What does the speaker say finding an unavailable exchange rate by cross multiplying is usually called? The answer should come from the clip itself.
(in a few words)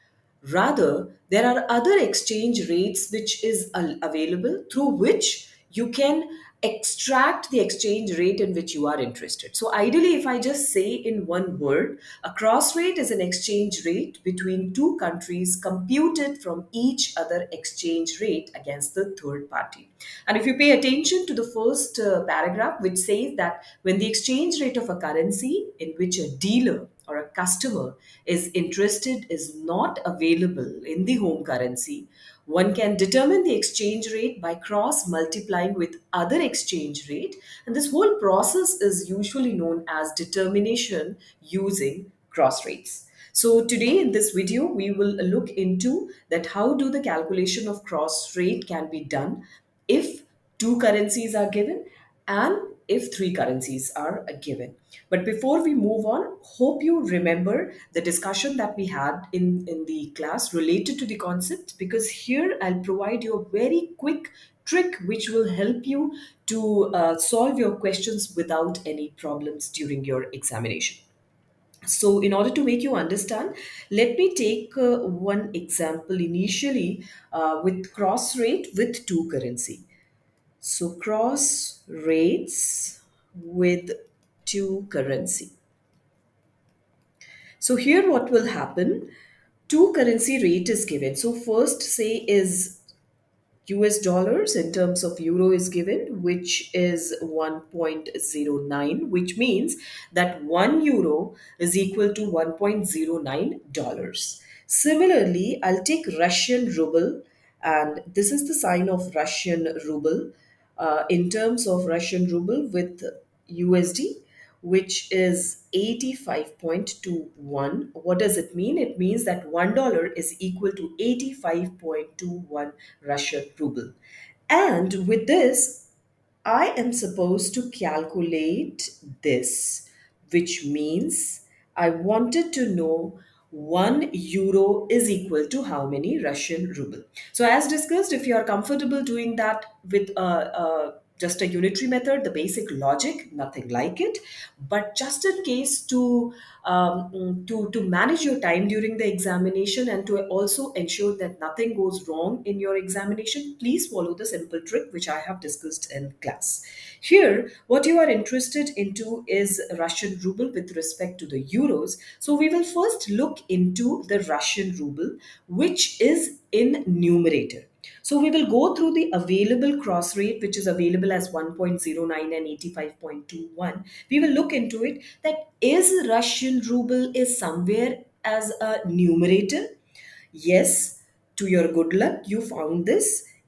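determination using cross rates.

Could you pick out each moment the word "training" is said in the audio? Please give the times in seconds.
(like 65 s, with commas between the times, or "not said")
not said.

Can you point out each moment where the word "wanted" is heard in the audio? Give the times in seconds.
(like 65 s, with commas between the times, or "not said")
131 s.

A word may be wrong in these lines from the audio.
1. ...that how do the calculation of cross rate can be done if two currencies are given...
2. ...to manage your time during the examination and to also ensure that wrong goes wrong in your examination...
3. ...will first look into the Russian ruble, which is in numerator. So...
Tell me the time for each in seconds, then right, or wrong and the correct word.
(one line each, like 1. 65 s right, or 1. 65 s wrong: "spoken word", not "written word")
1. 46 s right
2. 147 s wrong: "nothing", not "wrong"
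3. 162 s right.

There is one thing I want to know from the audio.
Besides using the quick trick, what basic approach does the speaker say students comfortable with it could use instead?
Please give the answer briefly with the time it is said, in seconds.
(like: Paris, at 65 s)
unitary method, at 141 s.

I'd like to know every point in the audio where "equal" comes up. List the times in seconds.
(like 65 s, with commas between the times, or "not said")
101 s, 120 s, 135 s.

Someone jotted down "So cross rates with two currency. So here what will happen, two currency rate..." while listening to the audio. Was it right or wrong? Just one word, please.
right.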